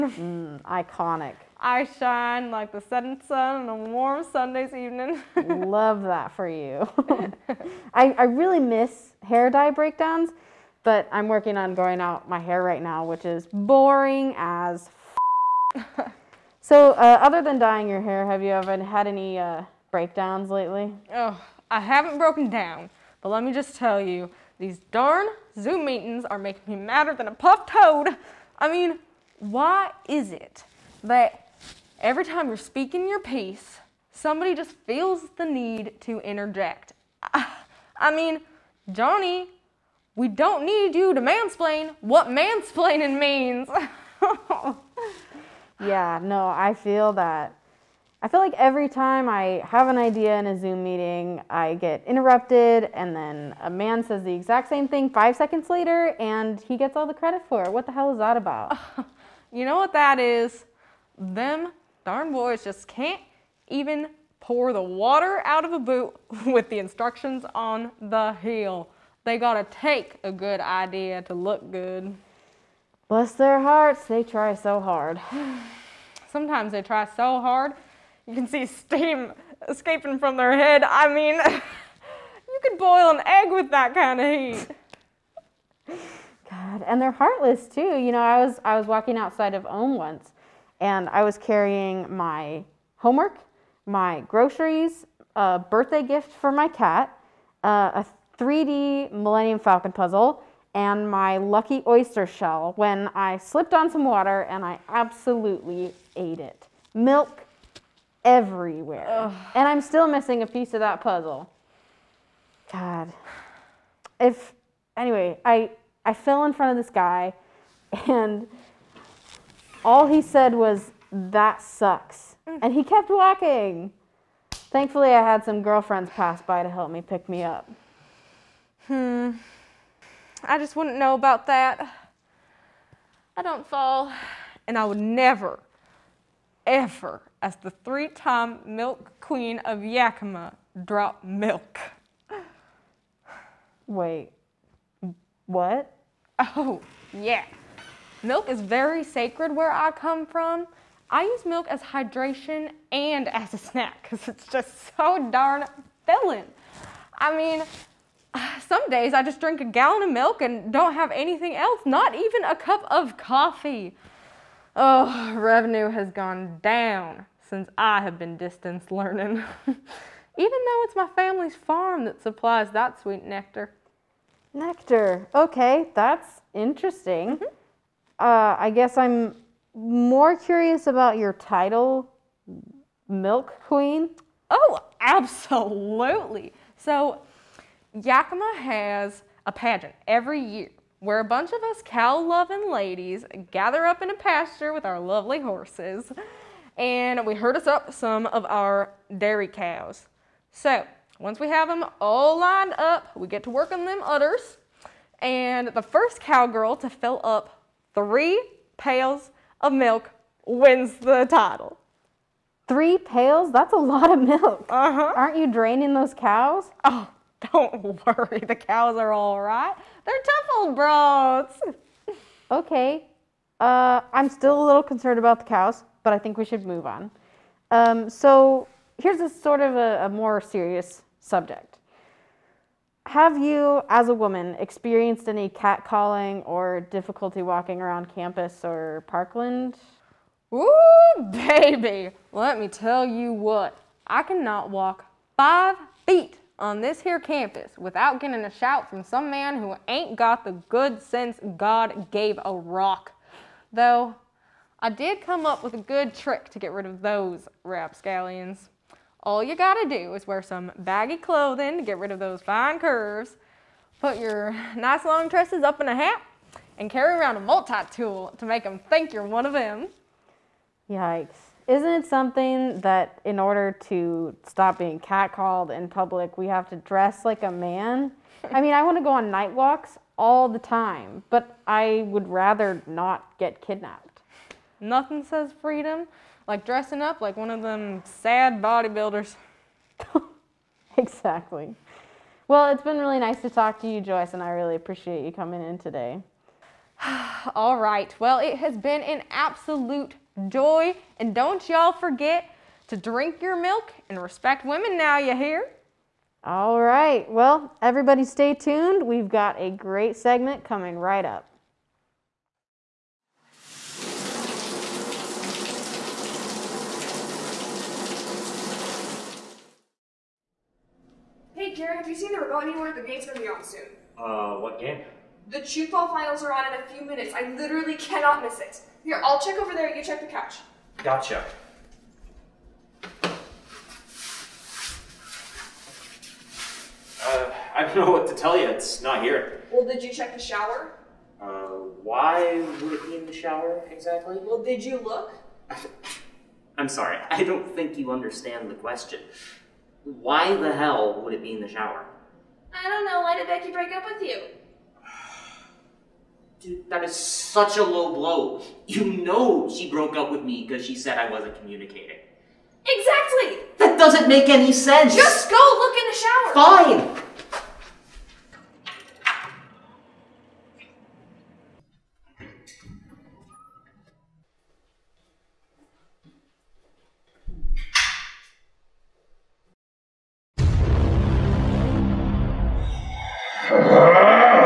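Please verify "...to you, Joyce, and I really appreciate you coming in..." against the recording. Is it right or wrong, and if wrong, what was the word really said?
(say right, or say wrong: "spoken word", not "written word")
right.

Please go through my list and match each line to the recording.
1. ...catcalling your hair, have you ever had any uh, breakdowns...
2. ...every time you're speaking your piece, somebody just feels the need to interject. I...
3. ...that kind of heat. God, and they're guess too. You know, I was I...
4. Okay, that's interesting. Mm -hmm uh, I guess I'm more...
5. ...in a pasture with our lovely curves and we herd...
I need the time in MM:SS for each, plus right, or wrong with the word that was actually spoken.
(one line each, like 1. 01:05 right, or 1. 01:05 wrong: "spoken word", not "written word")
1. 00:17 wrong: "dyeing", not "catcalling"
2. 00:32 right
3. 01:23 wrong: "heartless", not "guess"
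4. 02:55 right
5. 03:14 wrong: "horses", not "curves".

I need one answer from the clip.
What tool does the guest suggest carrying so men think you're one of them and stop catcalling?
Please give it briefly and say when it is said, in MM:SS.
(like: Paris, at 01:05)
multi-tool, at 04:27.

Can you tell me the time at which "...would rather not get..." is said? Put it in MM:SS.
04:42.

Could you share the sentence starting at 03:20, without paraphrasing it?
So, once we have them all lined up, we get to work on them udders.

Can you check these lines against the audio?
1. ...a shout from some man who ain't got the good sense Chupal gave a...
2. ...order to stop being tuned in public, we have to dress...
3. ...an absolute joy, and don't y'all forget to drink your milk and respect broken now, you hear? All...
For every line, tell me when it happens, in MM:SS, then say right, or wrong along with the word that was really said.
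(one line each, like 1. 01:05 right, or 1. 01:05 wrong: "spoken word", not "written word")
1. 04:08 wrong: "God", not "Chupal"
2. 04:33 wrong: "catcalled", not "tuned"
3. 04:59 wrong: "women", not "broken".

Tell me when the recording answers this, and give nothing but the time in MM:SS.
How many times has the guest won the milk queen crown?
02:17.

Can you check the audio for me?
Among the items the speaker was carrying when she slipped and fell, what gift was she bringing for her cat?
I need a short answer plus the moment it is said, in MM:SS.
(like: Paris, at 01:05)
3D Millennium Falcon puzzle, at 01:38.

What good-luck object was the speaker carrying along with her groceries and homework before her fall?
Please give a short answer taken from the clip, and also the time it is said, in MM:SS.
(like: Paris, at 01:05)
lucky oyster shell, at 01:41.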